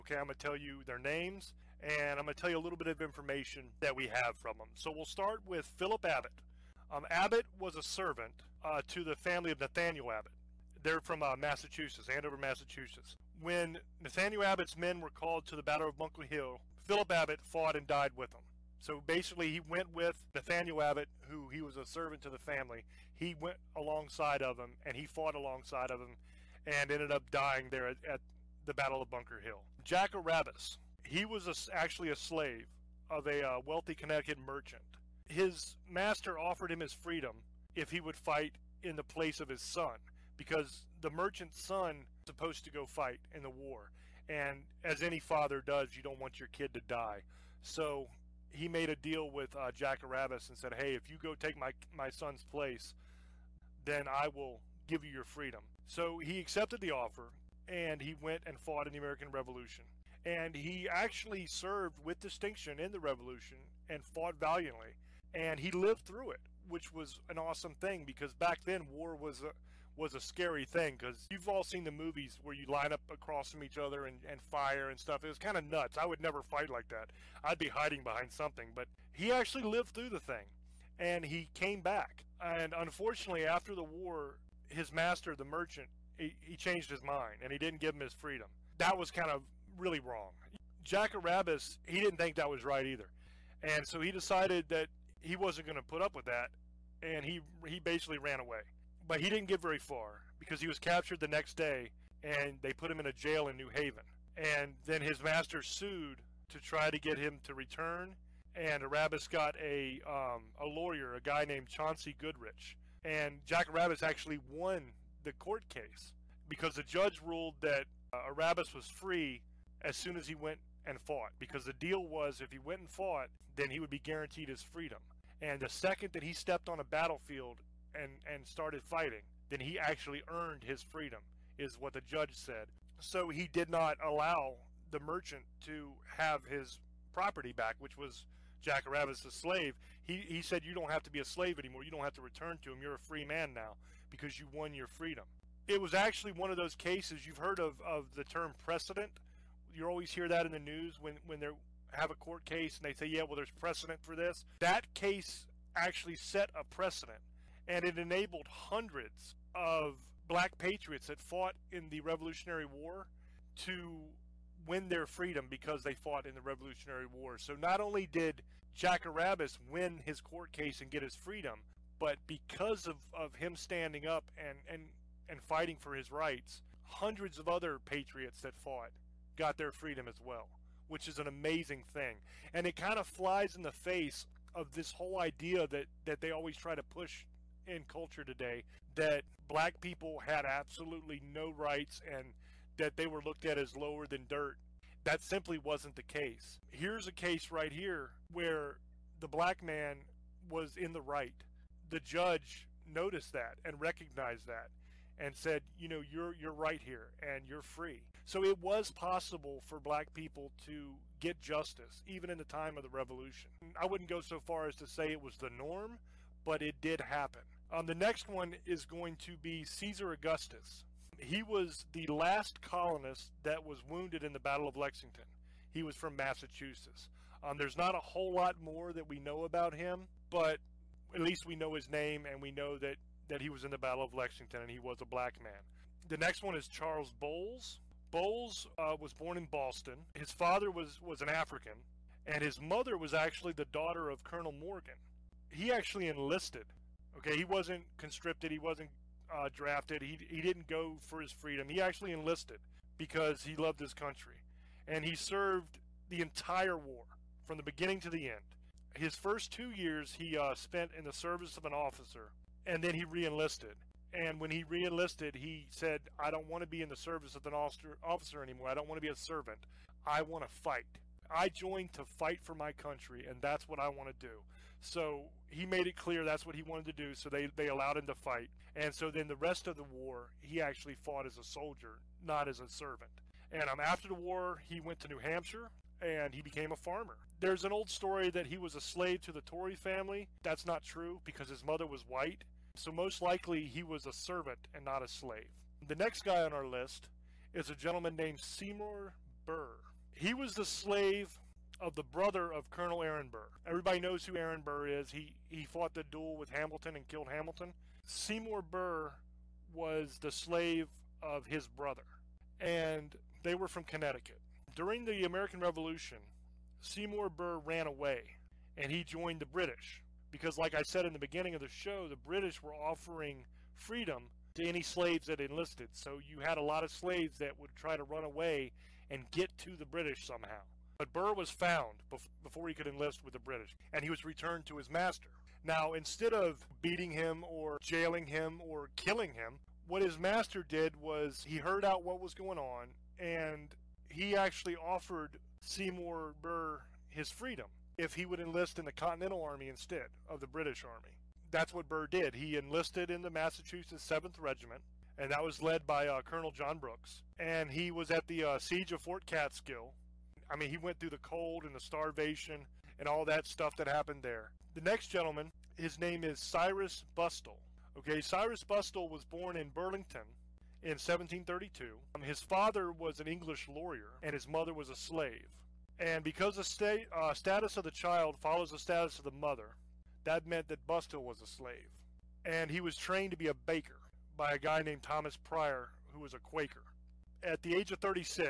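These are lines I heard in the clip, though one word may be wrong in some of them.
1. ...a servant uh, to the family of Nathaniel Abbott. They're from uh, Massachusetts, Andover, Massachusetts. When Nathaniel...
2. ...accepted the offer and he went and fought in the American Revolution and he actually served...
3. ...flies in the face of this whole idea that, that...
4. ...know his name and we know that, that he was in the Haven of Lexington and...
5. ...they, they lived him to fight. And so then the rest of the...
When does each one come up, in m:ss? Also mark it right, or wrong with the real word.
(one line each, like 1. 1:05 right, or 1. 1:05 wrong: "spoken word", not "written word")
1. 0:07 right
2. 0:56 right
3. 3:03 right
4. 3:51 wrong: "Battle", not "Haven"
5. 4:37 wrong: "allowed", not "lived".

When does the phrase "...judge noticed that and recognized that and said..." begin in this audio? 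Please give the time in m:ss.
3:22.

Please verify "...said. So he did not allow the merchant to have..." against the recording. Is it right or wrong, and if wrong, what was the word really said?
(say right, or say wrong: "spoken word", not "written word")
right.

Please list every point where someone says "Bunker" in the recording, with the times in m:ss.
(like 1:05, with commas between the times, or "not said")
0:15, 0:29.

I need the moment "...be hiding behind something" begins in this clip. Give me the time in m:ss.
1:17.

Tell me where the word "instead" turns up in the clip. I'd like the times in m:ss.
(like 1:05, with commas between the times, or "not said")
5:35, 5:49.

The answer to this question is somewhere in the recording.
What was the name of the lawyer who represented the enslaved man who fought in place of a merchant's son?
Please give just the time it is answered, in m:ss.
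1:51.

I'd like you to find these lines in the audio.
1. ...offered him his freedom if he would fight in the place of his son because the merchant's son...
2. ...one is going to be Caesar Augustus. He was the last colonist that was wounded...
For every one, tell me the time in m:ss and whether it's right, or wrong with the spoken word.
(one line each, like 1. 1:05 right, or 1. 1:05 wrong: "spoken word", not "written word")
1. 0:36 right
2. 3:38 right.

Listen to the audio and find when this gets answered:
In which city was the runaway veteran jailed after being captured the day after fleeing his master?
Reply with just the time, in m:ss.
1:43.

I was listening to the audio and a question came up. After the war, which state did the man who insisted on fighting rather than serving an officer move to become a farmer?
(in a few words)
New Hampshire.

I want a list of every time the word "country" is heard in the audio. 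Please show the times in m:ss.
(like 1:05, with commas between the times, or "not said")
4:13, 4:32.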